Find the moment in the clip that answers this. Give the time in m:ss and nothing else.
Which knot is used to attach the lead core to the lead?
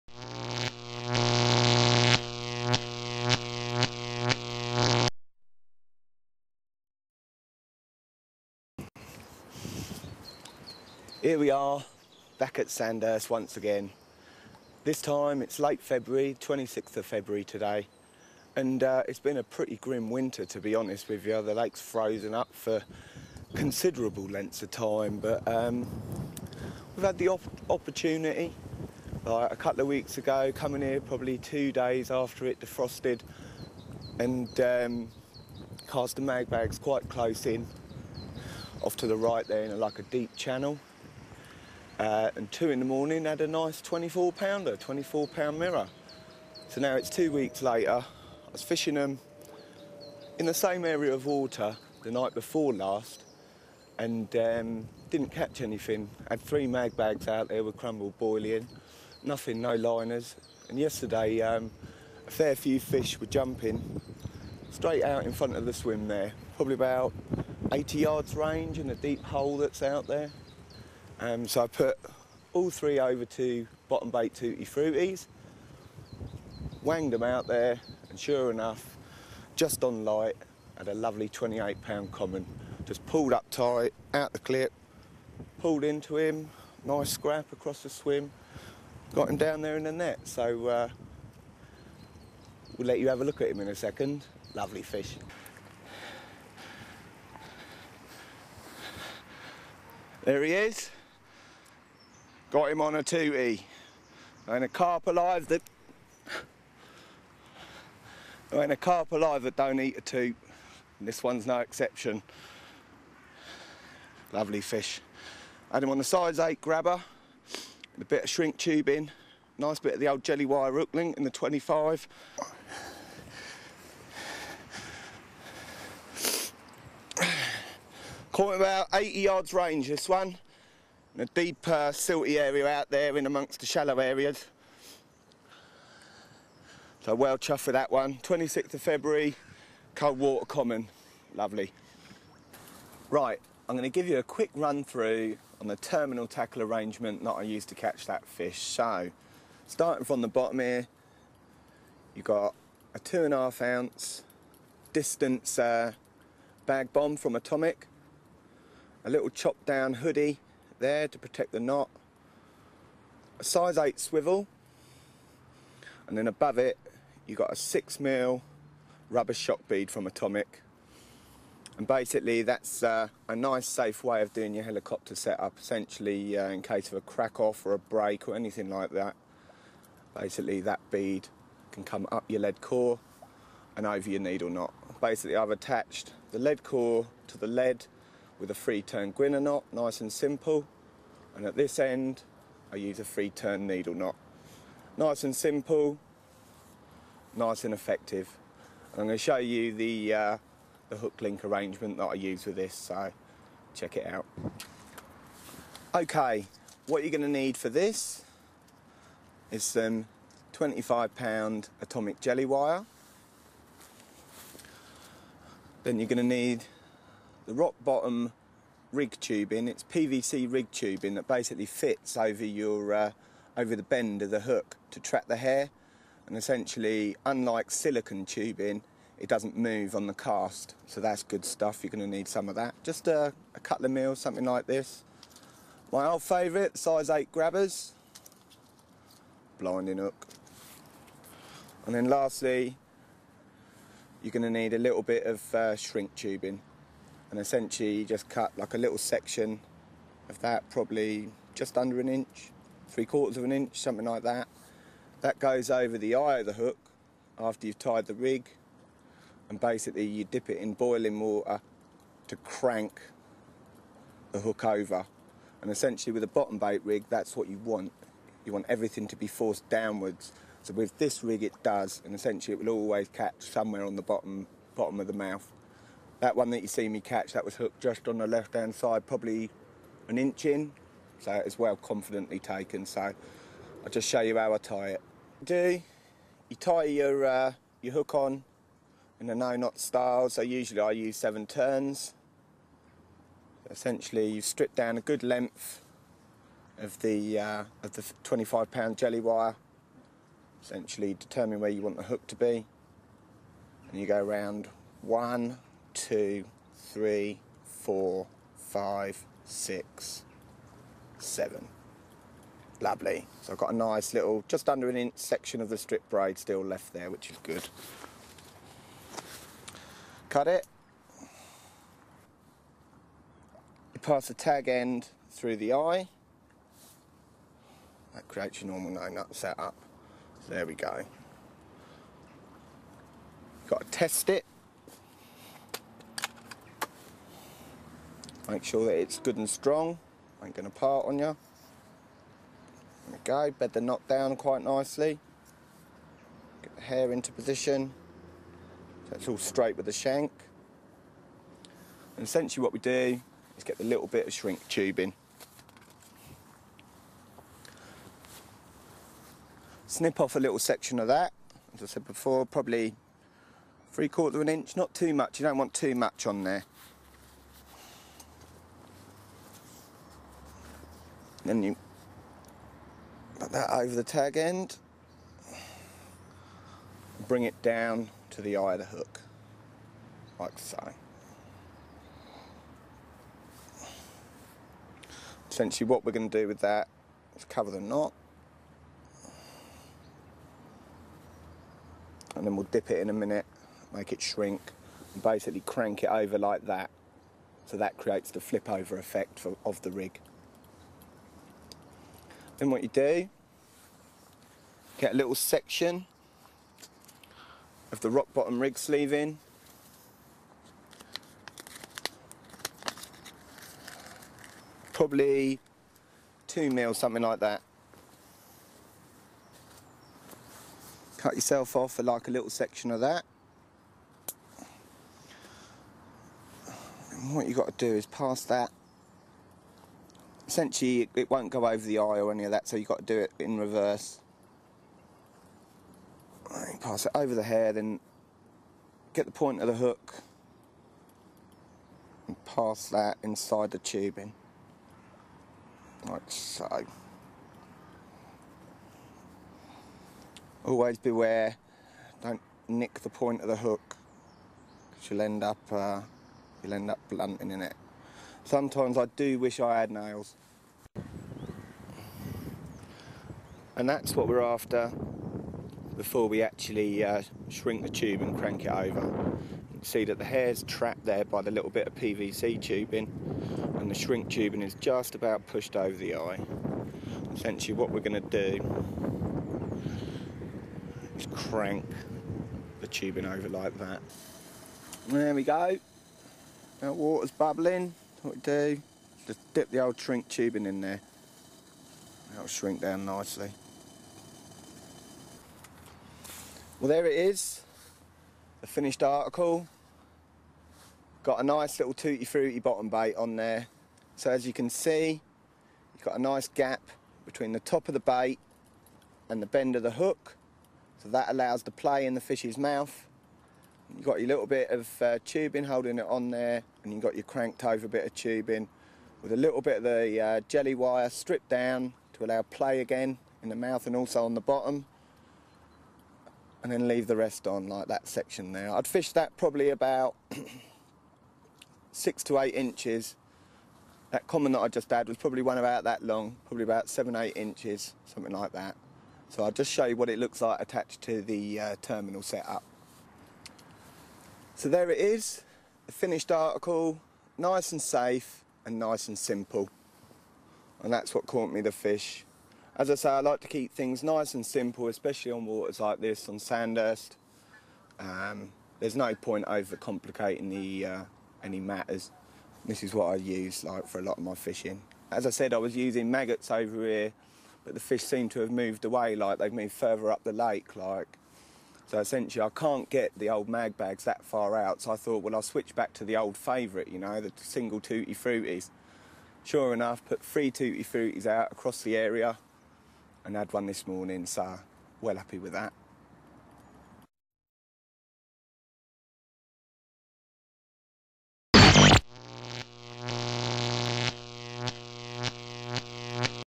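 3:08.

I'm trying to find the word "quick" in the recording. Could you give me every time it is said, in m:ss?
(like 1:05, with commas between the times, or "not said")
2:24.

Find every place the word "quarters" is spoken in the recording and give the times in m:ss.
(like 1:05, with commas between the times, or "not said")
4:13, 6:04.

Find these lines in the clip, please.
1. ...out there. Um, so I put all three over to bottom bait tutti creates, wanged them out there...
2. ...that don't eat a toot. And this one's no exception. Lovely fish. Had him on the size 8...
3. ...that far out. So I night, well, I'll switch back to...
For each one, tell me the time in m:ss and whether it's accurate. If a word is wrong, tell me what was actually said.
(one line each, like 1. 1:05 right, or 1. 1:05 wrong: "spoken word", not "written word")
1. 1:09 wrong: "fruities", not "creates"
2. 1:49 right
3. 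9:34 wrong: "thought", not "night".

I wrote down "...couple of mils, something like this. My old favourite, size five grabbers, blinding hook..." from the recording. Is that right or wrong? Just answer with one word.
wrong.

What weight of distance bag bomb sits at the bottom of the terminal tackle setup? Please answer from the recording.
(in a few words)
2.5 ounces.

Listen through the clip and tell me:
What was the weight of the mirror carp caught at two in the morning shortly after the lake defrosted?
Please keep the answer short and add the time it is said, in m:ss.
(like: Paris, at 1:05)
24 pounds, at 0:44.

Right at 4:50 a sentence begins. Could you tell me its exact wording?
So usually I use seven turns.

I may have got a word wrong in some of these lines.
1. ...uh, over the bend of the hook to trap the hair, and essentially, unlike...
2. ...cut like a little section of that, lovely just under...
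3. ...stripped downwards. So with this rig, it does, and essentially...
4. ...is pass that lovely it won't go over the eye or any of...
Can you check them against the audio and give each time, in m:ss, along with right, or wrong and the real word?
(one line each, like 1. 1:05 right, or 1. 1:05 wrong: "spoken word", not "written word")
1. 3:42 right
2. 4:08 wrong: "probably", not "lovely"
3. 4:29 wrong: "forced", not "stripped"
4. 7:07 wrong: "essentially", not "lovely".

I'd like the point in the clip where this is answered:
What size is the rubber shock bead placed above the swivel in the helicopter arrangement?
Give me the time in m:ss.
2:47.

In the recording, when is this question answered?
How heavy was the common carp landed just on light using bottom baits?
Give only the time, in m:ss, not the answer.
1:21.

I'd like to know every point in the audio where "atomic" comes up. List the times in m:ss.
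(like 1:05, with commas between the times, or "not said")
2:37, 2:50, 3:31.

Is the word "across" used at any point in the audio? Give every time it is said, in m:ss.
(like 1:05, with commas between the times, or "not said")
1:27, 9:41.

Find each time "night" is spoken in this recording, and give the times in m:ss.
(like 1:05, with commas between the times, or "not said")
0:52.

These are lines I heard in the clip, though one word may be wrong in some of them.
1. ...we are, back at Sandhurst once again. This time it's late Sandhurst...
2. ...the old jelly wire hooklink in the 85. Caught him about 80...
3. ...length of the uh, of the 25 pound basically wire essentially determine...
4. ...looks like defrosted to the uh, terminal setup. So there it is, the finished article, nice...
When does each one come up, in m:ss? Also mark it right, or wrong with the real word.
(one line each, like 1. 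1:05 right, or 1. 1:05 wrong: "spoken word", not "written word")
1. 0:11 wrong: "February", not "Sandhurst"
2. 2:00 wrong: "25", not "85"
3. 4:55 wrong: "jelly", not "basically"
4. 9:00 wrong: "attached", not "defrosted".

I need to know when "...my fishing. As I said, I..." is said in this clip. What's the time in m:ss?
9:24.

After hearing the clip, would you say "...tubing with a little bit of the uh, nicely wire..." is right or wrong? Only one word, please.
wrong.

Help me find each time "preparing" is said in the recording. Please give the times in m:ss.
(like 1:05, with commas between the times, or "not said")
not said.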